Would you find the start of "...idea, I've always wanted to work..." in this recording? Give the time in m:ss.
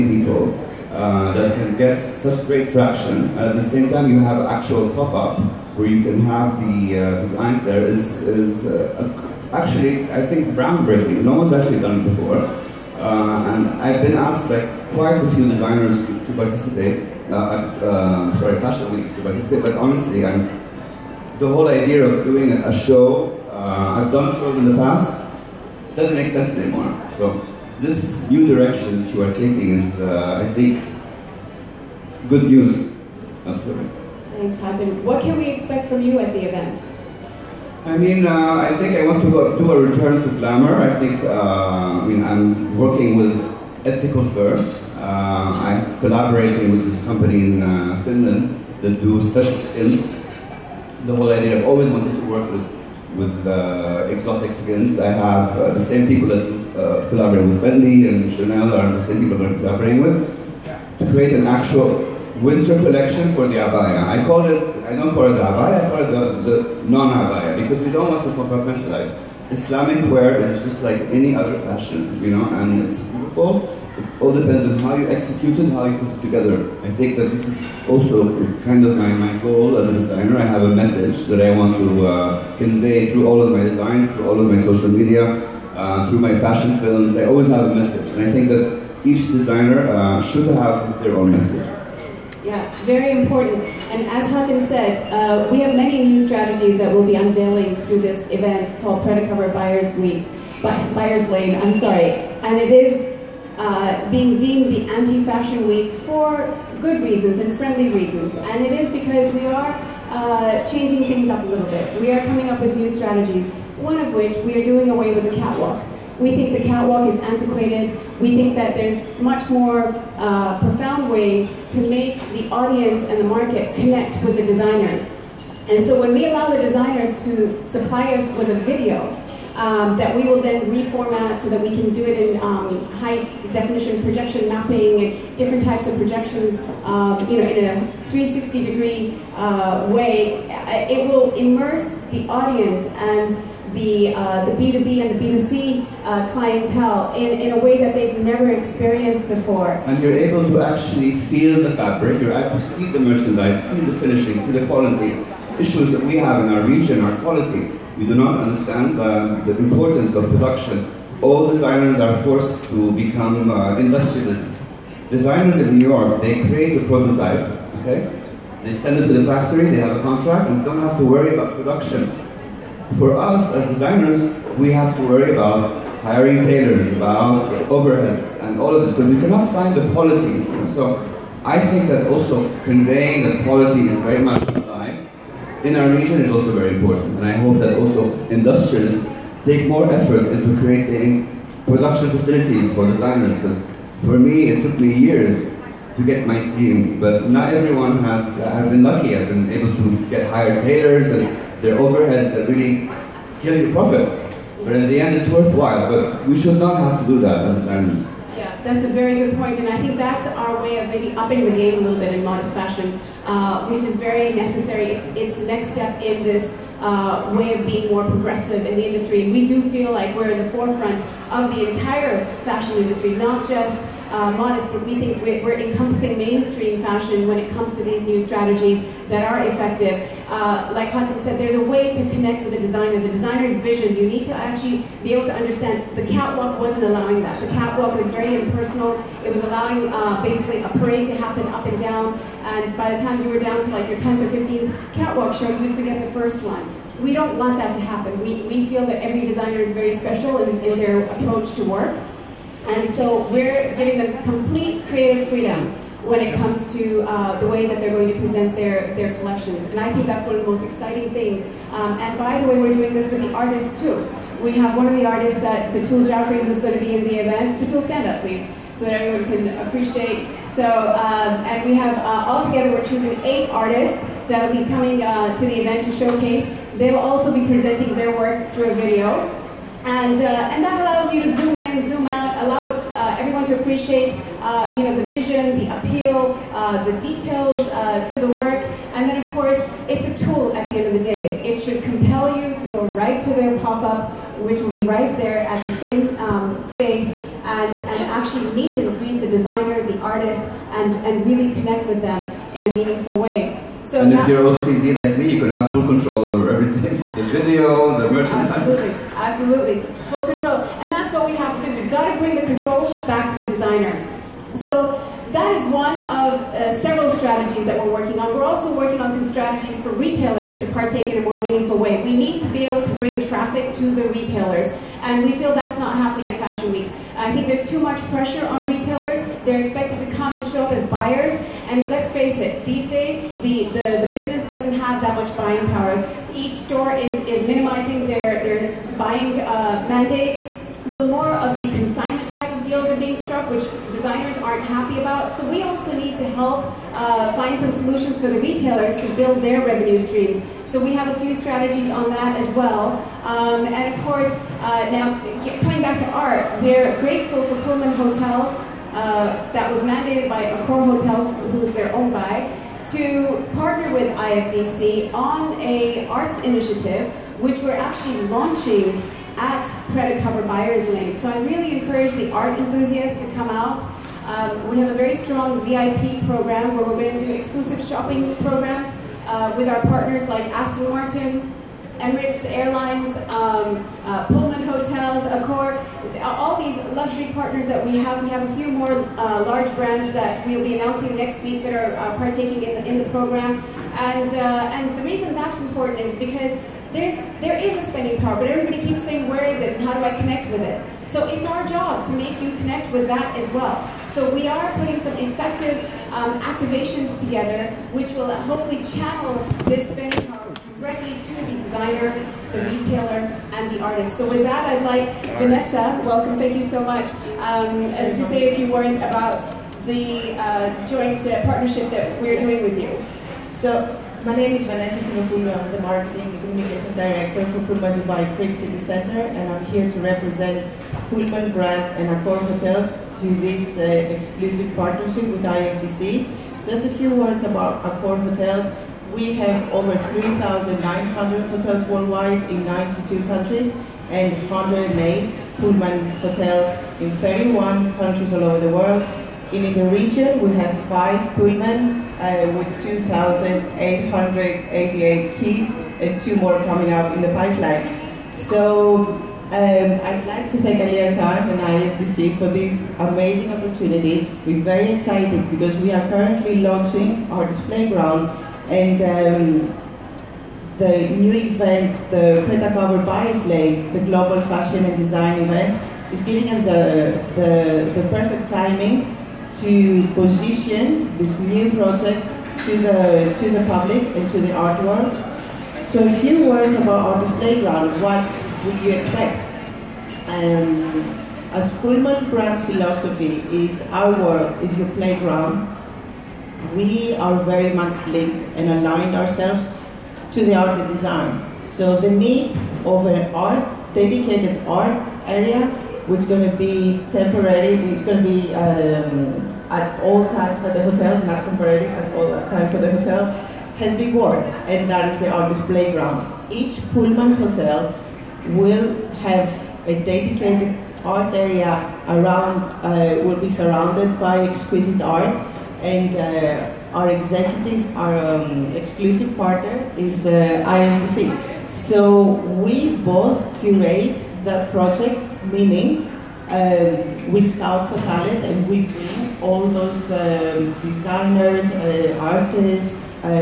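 0:51.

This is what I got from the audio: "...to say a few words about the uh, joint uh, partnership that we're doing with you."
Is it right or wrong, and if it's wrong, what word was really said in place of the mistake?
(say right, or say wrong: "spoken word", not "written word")
right.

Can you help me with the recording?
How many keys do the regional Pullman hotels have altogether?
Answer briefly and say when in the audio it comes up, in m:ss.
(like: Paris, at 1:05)
2,888, at 7:32.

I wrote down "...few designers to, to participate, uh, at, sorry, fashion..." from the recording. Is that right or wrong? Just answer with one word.
right.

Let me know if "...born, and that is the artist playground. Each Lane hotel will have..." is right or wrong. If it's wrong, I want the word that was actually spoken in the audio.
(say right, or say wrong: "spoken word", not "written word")
wrong: "Pullman", not "Lane".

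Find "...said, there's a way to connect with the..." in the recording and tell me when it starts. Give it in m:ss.
3:51.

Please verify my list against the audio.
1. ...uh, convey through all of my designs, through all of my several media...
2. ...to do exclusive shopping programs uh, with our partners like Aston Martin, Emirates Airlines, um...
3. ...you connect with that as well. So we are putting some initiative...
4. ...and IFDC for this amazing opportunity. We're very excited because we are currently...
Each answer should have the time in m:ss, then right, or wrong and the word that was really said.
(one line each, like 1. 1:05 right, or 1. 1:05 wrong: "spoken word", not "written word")
1. 1:22 wrong: "social", not "several"
2. 6:17 right
3. 6:42 wrong: "effective", not "initiative"
4. 7:41 right.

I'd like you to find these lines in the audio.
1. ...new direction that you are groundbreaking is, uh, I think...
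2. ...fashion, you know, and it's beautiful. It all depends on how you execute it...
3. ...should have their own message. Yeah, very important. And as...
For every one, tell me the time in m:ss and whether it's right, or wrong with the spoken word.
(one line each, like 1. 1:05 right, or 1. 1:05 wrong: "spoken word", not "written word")
1. 0:28 wrong: "taking", not "groundbreaking"
2. 1:11 right
3. 1:30 right.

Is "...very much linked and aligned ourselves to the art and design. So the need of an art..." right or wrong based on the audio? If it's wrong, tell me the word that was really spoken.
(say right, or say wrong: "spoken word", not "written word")
right.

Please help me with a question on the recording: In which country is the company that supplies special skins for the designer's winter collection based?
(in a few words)
Finland.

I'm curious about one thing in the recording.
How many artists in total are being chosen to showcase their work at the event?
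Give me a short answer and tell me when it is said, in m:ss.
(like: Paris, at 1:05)
8, at 4:33.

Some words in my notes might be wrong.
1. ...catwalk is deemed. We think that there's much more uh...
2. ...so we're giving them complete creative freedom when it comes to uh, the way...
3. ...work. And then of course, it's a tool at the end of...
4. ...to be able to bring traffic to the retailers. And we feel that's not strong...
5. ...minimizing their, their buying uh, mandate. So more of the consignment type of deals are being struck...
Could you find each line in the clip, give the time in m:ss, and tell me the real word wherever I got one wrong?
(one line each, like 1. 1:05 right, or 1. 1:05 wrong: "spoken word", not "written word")
1. 1:56 wrong: "antiquated", not "deemed"
2. 4:12 right
3. 4:48 right
4. 5:22 wrong: "happening", not "strong"
5. 5:37 right.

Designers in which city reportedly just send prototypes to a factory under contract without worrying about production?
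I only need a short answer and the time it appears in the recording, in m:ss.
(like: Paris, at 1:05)
New York, at 2:45.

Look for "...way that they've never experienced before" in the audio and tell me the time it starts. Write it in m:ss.
2:27.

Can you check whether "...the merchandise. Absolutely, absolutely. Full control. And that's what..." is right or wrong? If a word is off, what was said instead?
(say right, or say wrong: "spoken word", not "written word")
right.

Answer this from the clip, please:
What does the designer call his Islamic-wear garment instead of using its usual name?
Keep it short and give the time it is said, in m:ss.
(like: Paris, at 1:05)
the non-Abaya, at 1:06.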